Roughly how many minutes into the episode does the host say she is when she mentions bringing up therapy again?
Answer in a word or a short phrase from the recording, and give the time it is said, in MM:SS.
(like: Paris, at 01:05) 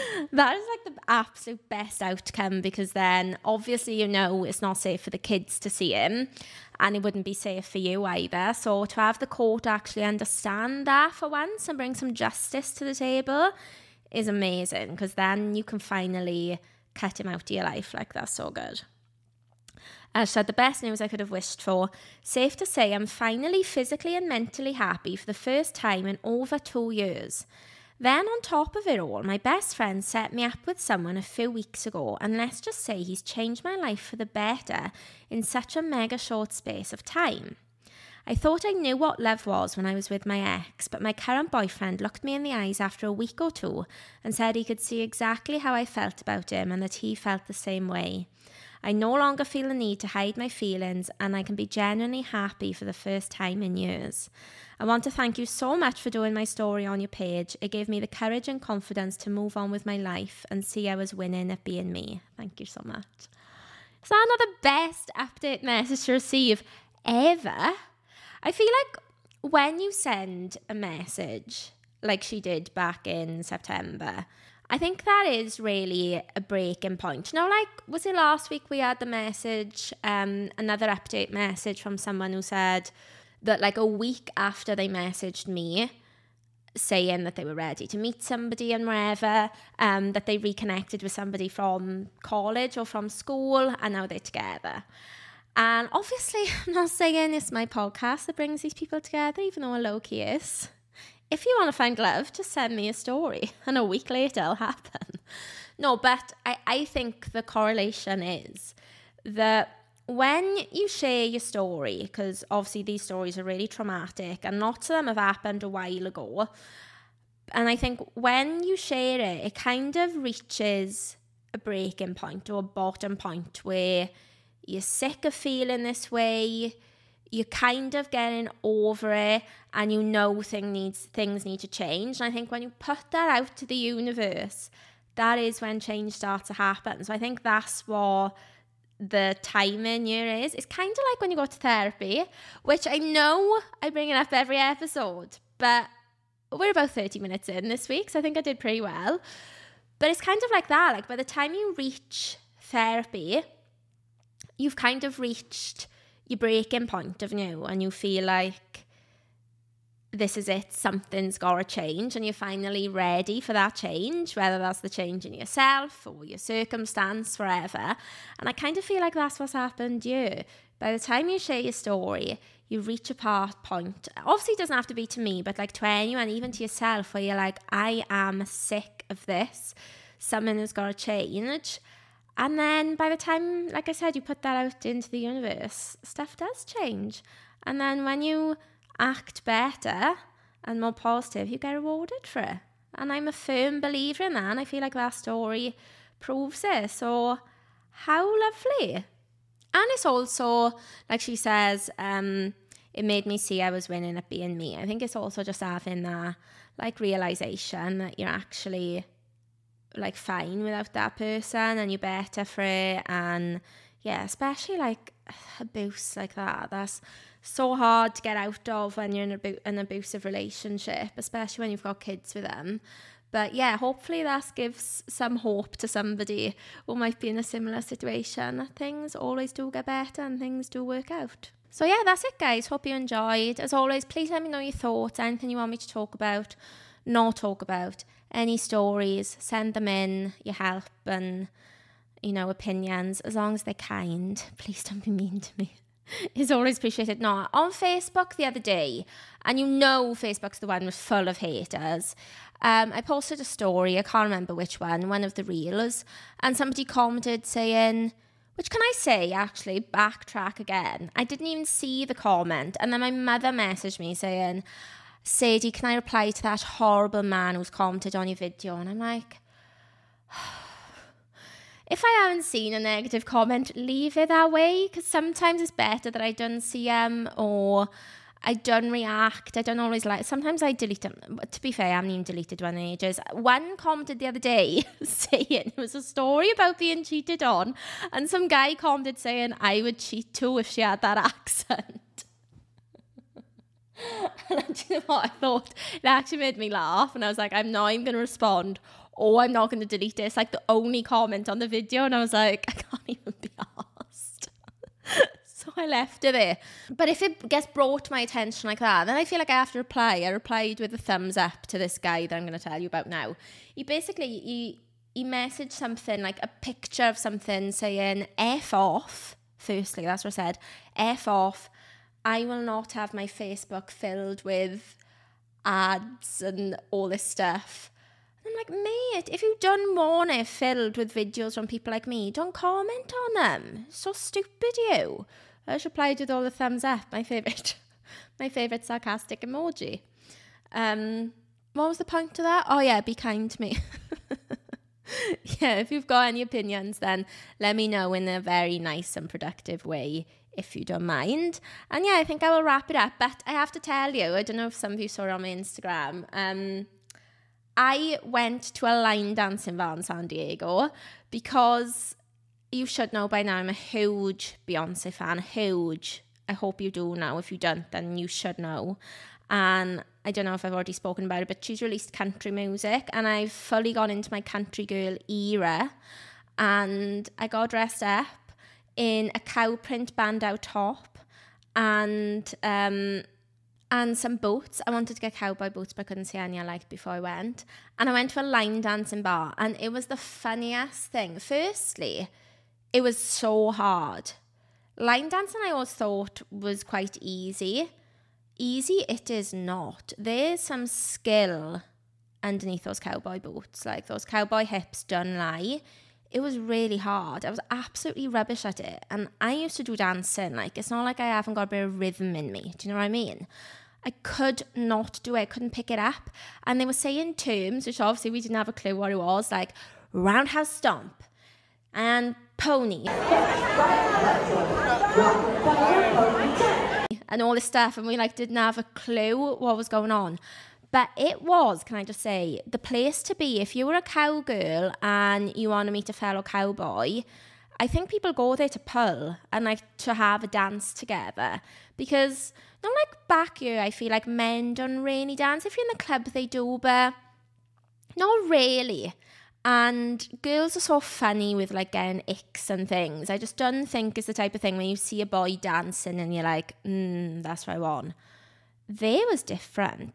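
30, at 02:26.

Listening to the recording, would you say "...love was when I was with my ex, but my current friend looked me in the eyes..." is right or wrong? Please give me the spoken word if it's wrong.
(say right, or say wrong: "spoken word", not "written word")
wrong: "boyfriend", not "friend".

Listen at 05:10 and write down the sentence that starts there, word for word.
I replied with a thumbs up to this guy that I'm going to tell you about now.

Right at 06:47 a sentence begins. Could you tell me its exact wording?
I was absolutely rubbish at it.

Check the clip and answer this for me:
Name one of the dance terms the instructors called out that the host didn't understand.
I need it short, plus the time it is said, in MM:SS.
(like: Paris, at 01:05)
Roundhouse stomp, at 07:00.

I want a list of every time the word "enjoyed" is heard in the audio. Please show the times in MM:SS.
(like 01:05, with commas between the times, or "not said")
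03:52.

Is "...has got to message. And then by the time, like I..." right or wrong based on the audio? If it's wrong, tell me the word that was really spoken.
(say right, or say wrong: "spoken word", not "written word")
wrong: "change", not "message".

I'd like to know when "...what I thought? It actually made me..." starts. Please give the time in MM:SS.
04:55.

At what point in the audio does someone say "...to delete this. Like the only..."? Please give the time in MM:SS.
04:59.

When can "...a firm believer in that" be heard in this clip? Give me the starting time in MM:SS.
03:13.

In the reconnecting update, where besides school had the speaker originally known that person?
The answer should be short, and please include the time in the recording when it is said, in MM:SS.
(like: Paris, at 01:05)
College, at 01:32.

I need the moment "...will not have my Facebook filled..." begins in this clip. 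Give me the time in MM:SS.
05:22.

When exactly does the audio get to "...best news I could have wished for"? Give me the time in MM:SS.
00:20.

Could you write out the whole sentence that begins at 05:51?
And yeah, I think I will wrap it up.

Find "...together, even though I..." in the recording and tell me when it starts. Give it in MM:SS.
01:38.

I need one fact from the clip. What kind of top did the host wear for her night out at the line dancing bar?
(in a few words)
Cow print bandeau top.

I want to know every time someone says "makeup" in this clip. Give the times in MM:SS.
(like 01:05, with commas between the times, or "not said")
not said.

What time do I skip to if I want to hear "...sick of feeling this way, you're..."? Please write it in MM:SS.
02:04.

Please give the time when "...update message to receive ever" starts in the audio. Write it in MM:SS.
01:05.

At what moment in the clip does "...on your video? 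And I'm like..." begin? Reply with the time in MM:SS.
04:28.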